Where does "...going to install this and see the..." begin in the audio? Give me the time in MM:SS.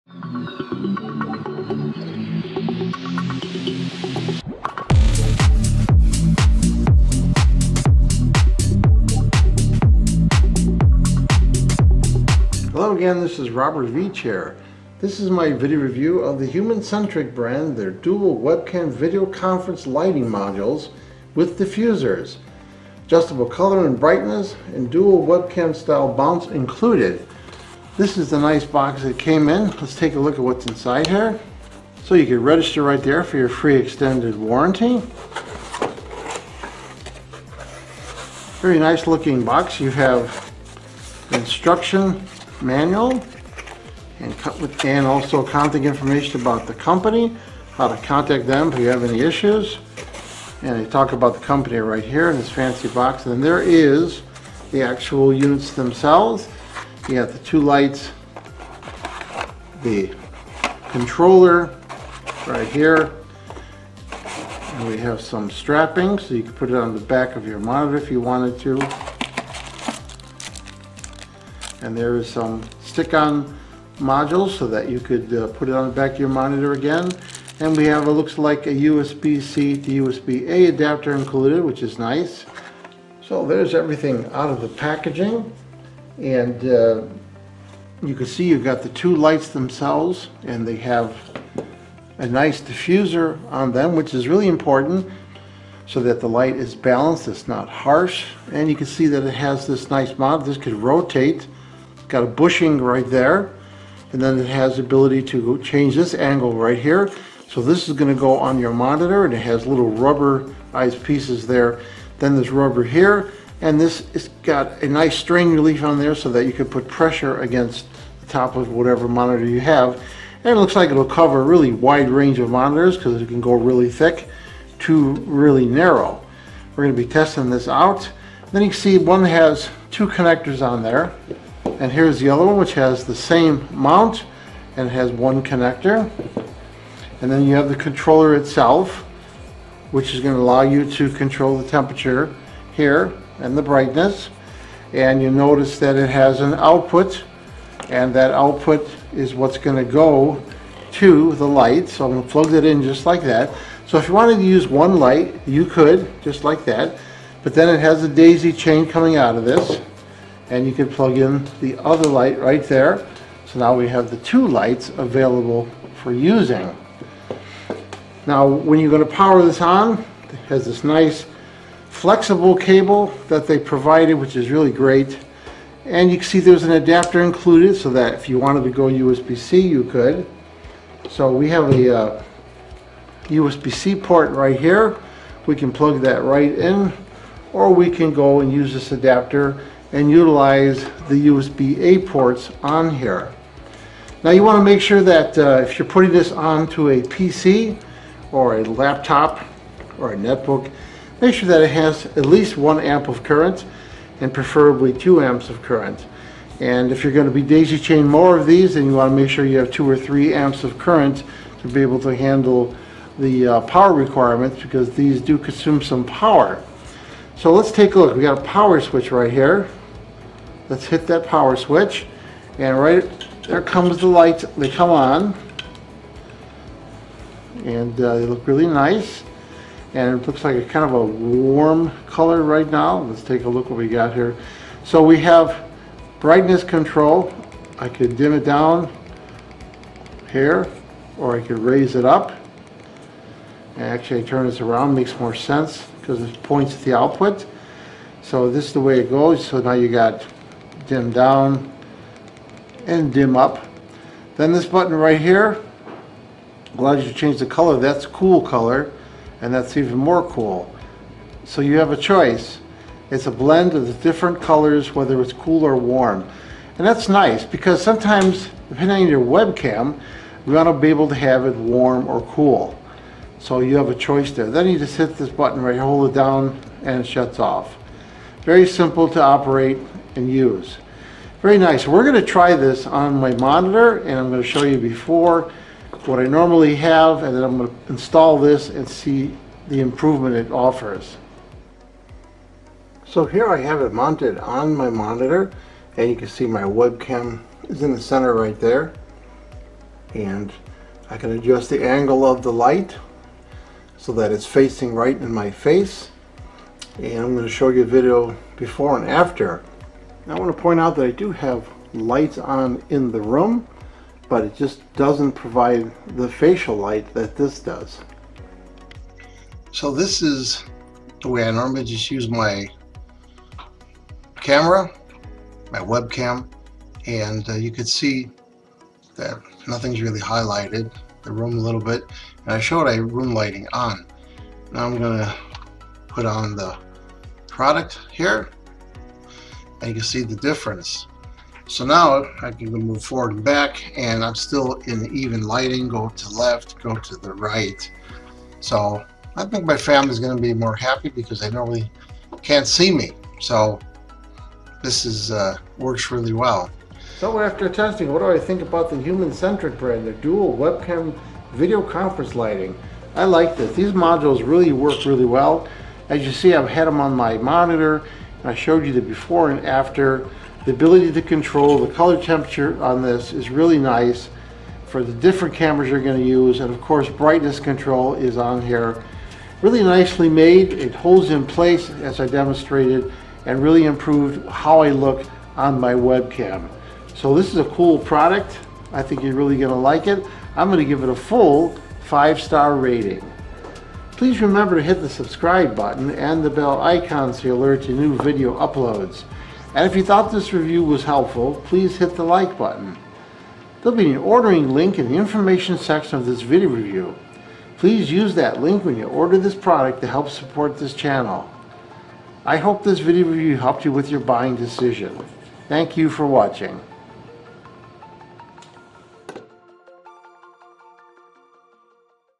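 04:47.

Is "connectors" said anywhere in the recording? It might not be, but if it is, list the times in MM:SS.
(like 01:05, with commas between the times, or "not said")
02:10, 02:15.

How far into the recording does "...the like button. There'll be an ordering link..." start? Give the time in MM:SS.
06:42.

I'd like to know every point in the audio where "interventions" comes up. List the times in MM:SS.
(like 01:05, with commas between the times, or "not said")
not said.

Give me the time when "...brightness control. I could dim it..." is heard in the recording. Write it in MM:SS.
03:56.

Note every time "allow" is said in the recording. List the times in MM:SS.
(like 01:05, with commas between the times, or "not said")
02:20, 04:16.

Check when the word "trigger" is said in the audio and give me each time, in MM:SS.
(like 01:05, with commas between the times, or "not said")
not said.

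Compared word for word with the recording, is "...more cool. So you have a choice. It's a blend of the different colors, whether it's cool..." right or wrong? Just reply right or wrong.
right.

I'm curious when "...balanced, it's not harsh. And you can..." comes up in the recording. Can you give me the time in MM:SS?
01:36.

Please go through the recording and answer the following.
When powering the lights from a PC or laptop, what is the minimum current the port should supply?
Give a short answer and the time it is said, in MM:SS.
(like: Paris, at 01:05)
1 amp, at 03:22.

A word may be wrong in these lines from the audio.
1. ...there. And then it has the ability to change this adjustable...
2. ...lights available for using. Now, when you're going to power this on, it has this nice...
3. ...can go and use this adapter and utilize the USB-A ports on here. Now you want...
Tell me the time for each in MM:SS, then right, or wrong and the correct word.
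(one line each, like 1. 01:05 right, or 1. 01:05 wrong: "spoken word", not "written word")
1. 01:43 wrong: "angle", not "adjustable"
2. 02:44 right
3. 03:07 right.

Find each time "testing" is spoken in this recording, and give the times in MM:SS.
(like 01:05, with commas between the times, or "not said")
02:07, 05:57.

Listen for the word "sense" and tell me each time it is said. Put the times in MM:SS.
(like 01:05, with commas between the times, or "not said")
04:05.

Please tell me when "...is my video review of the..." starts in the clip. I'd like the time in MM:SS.
00:15.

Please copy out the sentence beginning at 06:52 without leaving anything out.
I hope this video review helped you with your buying decision.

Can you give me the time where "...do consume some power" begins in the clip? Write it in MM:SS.
03:35.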